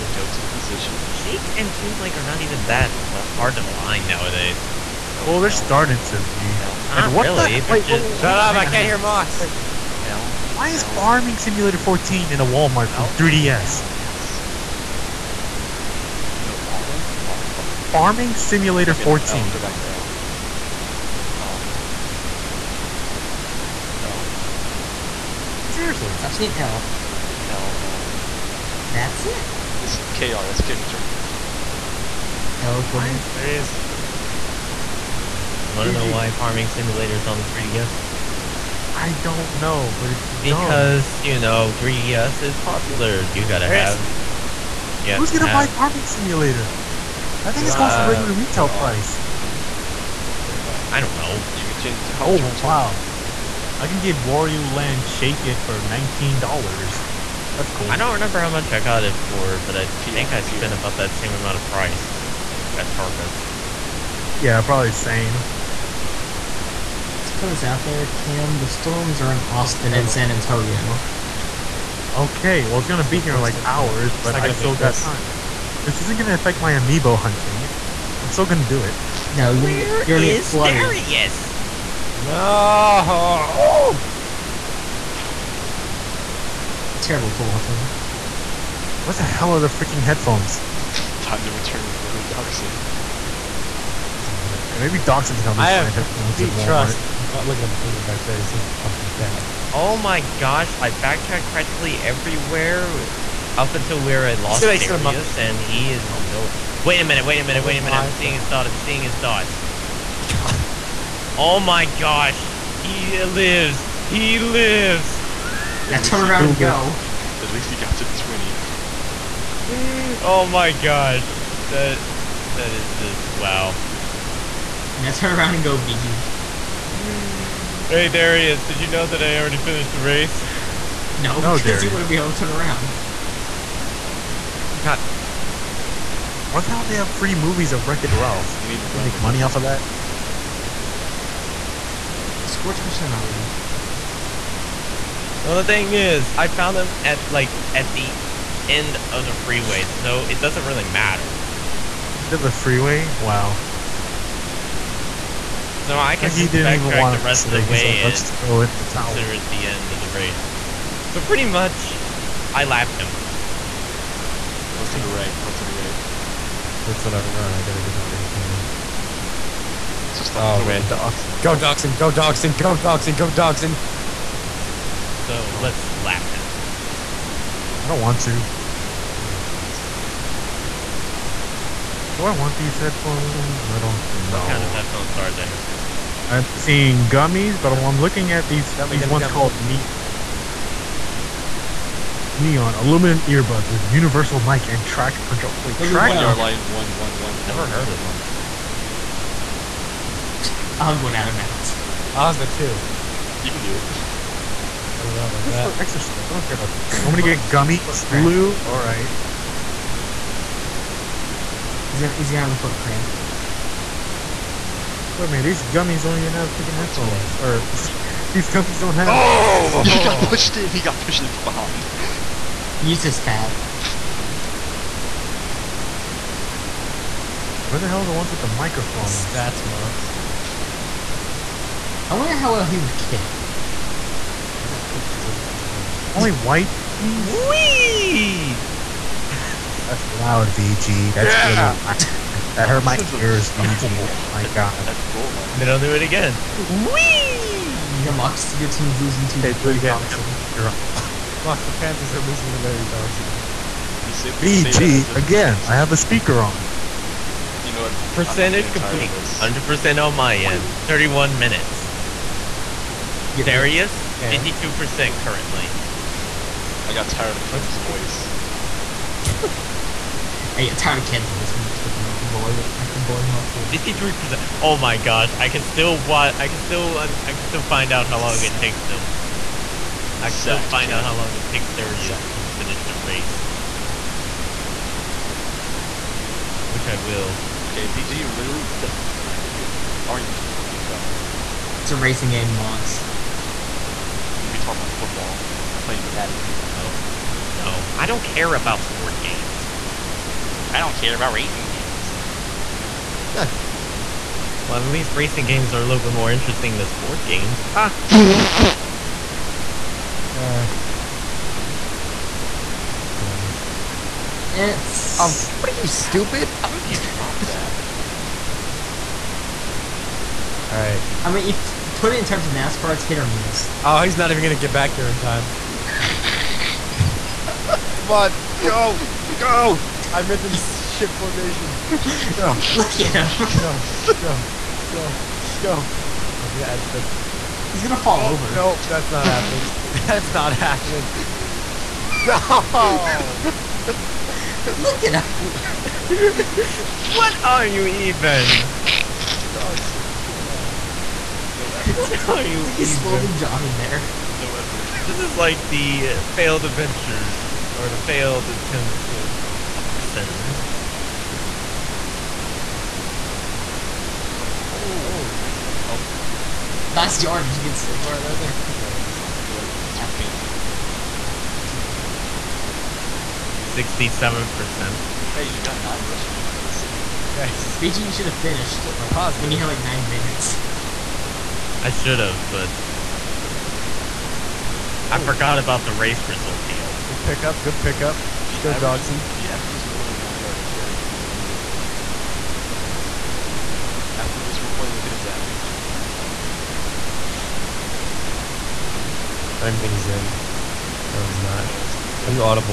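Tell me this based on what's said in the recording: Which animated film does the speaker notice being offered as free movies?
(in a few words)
Wreck-It Ralph.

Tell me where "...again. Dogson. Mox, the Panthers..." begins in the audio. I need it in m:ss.
4:09.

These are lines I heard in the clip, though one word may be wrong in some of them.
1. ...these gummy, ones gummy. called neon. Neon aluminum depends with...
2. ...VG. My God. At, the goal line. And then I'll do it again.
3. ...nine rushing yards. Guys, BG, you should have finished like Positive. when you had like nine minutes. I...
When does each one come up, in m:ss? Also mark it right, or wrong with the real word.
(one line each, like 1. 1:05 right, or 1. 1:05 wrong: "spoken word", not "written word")
1. 3:08 wrong: "earbuds", not "depends"
2. 4:03 right
3. 6:15 right.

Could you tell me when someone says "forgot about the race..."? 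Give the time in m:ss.
6:25.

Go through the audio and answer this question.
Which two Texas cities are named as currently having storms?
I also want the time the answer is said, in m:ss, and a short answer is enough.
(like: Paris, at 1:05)
Austin and San Antonio, at 1:09.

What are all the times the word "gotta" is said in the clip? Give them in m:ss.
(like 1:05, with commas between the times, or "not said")
0:43, 2:47.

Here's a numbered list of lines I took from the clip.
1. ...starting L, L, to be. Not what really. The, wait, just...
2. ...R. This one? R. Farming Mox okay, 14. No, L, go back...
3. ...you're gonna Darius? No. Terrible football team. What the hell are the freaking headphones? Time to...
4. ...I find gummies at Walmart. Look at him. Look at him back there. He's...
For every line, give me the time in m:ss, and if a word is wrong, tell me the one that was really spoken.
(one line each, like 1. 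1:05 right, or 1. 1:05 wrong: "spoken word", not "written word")
1. 0:05 right
2. 0:16 wrong: "Simulator", not "Mox"
3. 1:20 right
4. 1:35 wrong: "headphones", not "gummies".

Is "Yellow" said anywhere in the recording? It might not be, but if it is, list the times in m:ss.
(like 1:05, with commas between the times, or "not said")
6:09.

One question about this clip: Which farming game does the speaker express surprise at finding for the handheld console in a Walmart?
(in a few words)
Farming Simulator 14.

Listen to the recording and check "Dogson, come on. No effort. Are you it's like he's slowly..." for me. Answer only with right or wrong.
right.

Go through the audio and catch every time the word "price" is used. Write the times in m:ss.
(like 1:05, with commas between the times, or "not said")
0:48, 1:01.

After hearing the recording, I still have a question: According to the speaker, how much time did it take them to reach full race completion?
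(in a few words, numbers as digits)
31 minutes.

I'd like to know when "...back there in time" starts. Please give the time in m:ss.
5:24.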